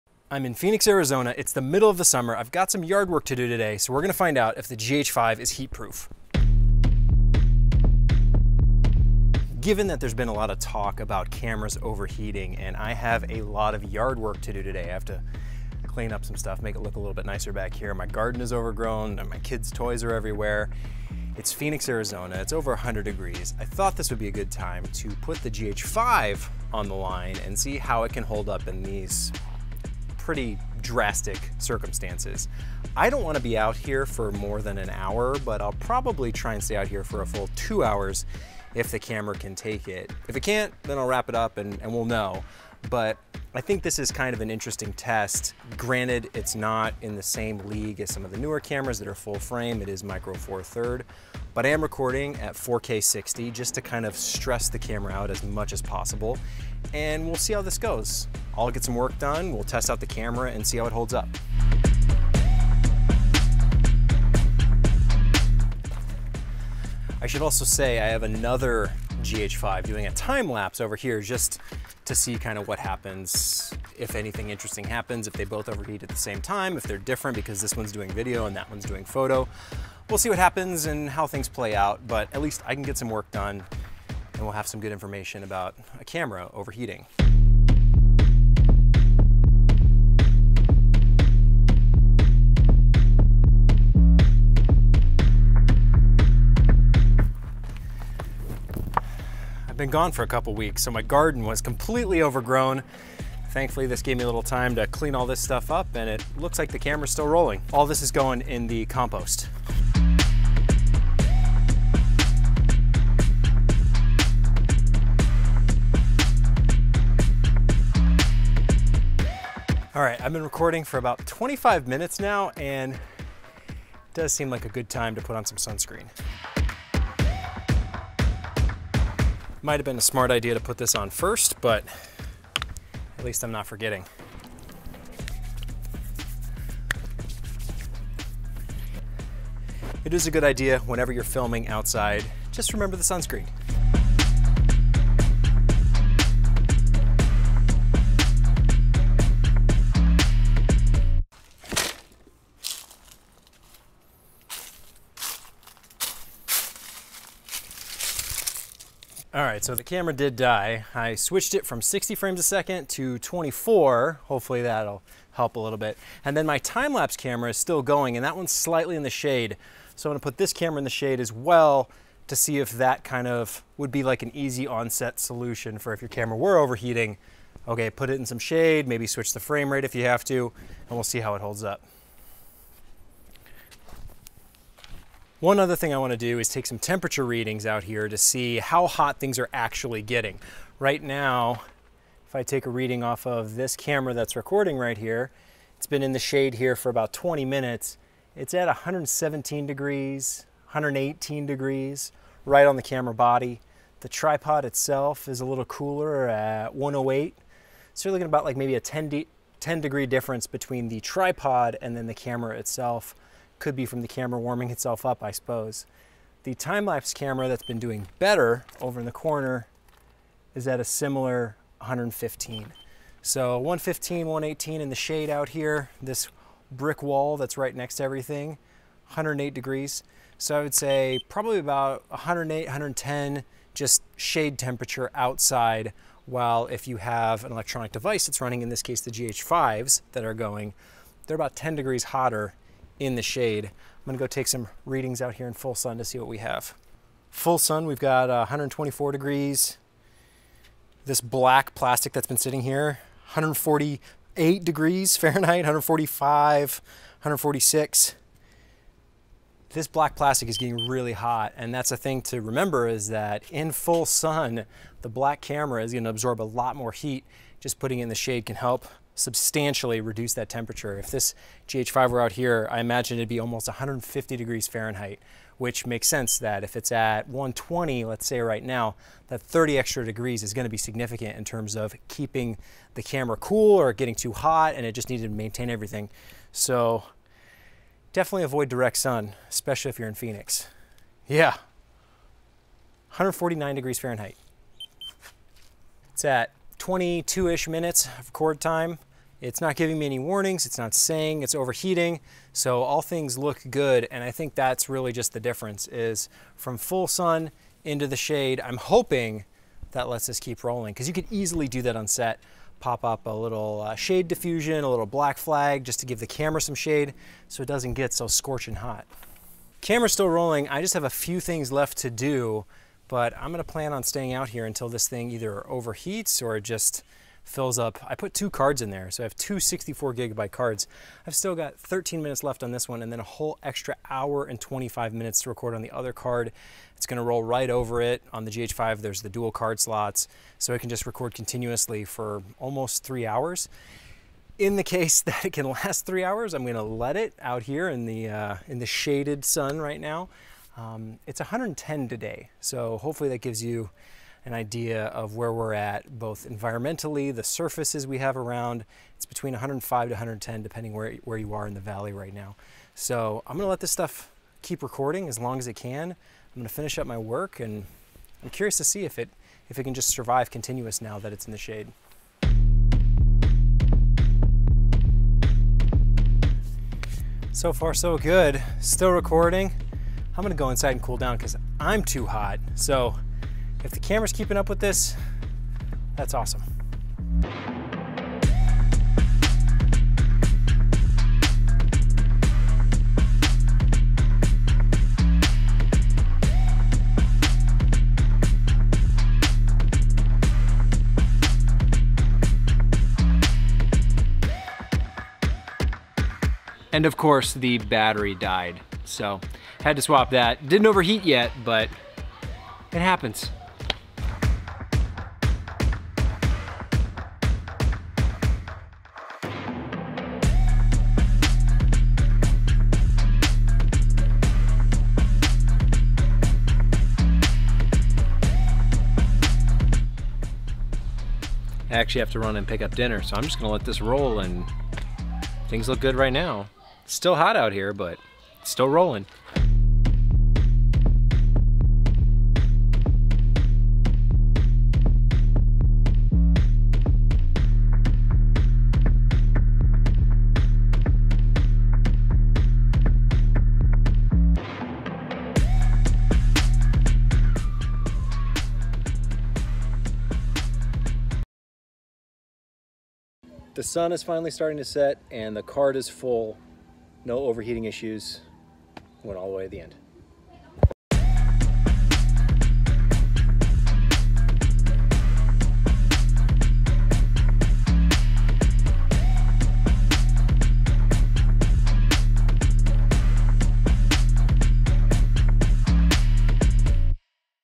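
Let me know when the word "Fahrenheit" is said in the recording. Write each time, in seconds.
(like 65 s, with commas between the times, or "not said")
255 s, 274 s, 293 s.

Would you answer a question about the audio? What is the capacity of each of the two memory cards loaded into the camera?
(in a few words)
64 gigabytes.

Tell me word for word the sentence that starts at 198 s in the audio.
It's at 117 degrees, 118 degrees, right on the camera body.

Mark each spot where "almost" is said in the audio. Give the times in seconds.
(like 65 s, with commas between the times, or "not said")
273 s, 342 s.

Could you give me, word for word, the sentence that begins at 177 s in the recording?
Okay, put it in some shade, maybe switch the frame rate if you have to, and we'll see how it holds up.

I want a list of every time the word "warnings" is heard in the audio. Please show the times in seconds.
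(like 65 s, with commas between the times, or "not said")
300 s.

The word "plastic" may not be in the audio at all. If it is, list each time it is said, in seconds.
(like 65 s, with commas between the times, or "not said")
251 s, 260 s.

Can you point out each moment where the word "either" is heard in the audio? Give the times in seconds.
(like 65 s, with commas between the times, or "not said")
325 s.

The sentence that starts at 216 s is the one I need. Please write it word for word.
The time-lapse camera that's been doing better over in the corner is at a similar 115.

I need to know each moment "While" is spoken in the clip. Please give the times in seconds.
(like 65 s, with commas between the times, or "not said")
236 s.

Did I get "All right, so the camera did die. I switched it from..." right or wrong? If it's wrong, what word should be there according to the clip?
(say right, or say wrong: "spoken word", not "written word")
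right.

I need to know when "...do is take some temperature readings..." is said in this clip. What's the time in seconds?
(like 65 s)
186 s.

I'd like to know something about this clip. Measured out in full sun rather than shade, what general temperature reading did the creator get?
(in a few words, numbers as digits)
124 degrees.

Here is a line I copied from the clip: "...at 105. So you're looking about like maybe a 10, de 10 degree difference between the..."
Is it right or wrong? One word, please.
wrong.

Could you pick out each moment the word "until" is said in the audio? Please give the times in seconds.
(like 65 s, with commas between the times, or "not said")
324 s.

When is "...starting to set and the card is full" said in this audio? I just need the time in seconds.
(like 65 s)
464 s.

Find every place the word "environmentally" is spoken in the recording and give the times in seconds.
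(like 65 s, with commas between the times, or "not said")
356 s.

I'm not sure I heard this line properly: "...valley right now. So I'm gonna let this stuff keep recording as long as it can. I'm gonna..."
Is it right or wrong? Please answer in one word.
right.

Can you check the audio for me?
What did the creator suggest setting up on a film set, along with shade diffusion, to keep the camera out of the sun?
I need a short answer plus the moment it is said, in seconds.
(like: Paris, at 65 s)
black flag, at 315 s.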